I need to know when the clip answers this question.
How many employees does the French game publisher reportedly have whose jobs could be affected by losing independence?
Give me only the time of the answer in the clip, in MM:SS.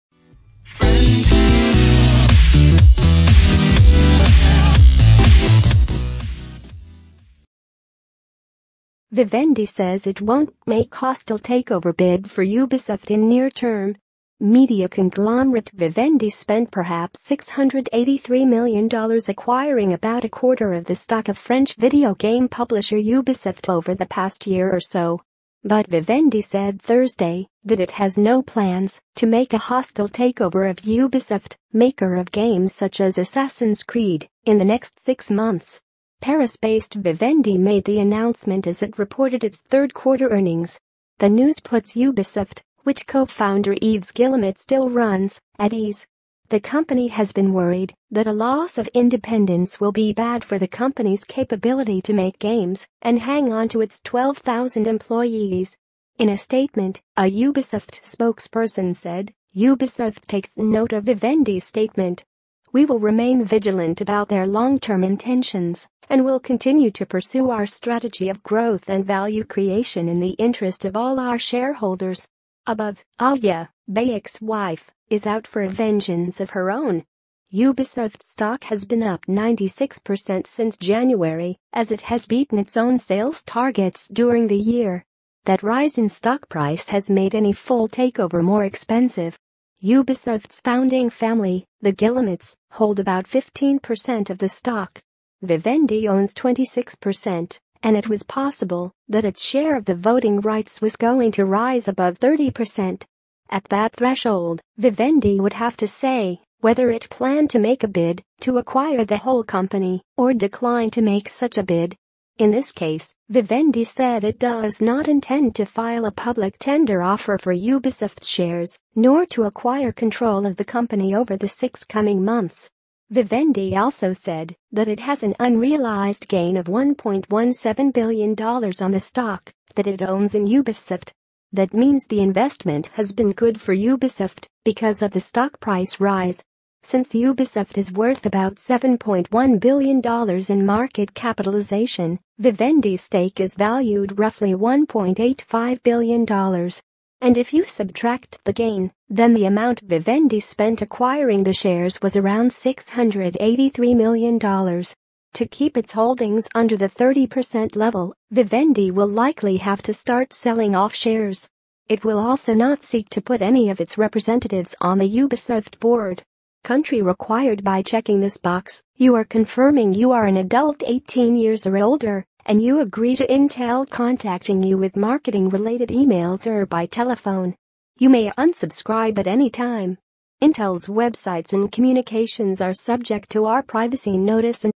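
00:54.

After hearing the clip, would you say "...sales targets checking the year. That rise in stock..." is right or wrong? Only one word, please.
wrong.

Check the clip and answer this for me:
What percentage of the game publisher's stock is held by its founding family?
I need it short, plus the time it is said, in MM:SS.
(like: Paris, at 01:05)
15%, at 01:33.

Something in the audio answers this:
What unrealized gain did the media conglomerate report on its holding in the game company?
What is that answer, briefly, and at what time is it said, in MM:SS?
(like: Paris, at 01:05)
$1.17 billion, at 02:06.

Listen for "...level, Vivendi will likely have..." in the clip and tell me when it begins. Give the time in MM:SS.
02:37.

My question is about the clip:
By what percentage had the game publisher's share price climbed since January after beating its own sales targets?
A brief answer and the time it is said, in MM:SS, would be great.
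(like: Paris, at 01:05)
96%, at 01:19.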